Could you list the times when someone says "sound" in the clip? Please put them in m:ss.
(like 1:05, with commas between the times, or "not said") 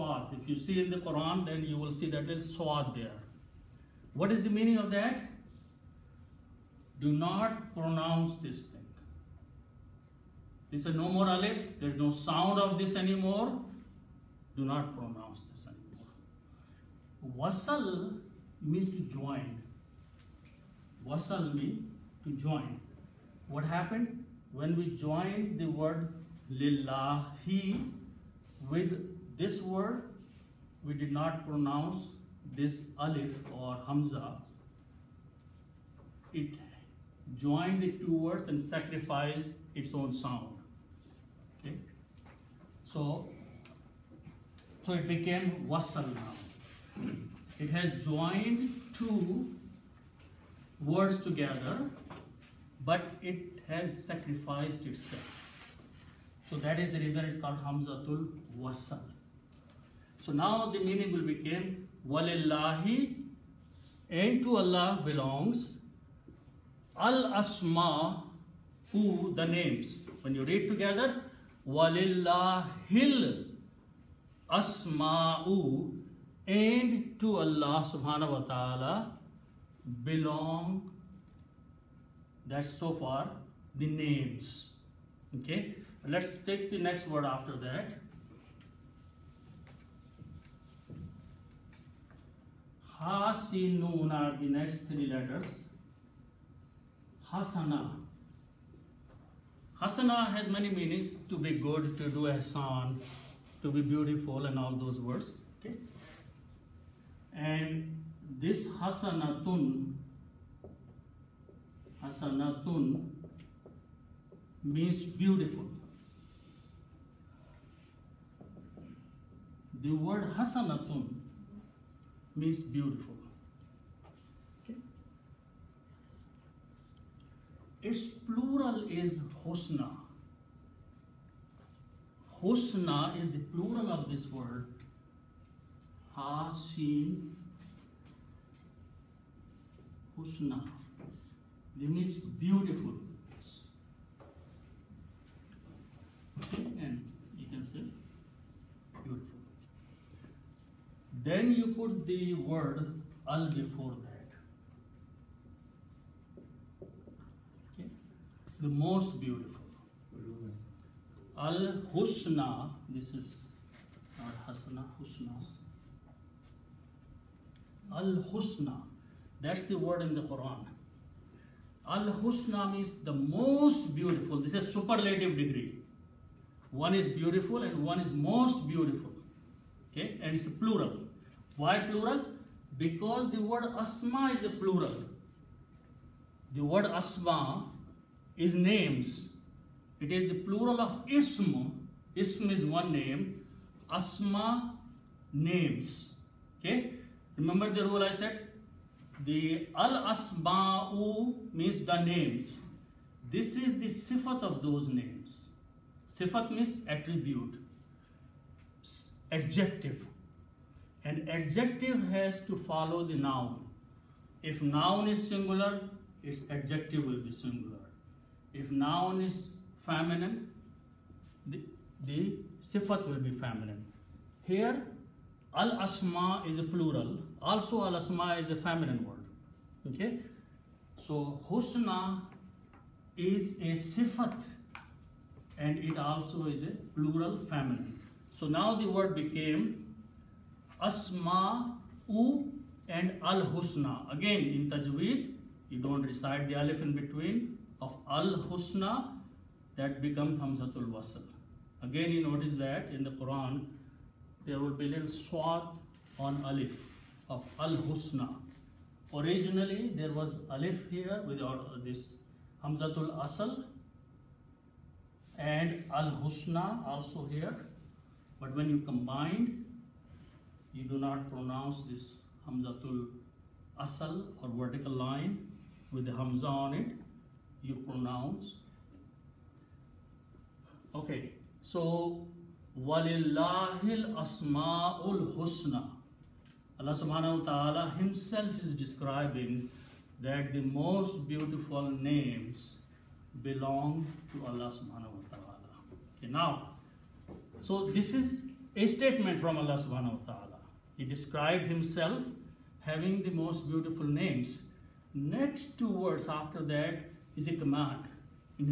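0:12, 0:40.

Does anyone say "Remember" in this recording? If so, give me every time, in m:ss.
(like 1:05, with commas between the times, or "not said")
3:17.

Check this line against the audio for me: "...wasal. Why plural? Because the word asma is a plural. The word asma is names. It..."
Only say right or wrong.
wrong.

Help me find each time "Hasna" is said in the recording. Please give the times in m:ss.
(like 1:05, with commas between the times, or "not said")
2:44.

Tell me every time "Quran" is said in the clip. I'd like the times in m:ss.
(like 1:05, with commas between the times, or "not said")
0:00, 2:50, 4:13.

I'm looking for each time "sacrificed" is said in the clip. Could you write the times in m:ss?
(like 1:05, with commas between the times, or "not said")
0:38, 0:54.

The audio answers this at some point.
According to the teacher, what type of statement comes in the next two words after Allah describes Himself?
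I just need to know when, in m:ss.
5:07.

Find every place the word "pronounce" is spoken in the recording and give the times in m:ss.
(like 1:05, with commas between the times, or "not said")
0:07, 0:14, 0:31, 4:31, 4:37.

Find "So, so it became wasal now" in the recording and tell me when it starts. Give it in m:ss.
0:42.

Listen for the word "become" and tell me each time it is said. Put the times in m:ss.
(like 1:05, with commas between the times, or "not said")
1:01, 4:10.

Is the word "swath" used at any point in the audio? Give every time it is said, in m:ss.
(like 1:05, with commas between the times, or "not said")
0:02, 4:15.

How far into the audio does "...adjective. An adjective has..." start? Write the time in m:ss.
3:29.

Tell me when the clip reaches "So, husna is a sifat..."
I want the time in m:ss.
3:51.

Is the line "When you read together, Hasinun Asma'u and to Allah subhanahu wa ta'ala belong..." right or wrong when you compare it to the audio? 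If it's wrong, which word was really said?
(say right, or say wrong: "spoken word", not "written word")
wrong: "Walillahil", not "Hasinun".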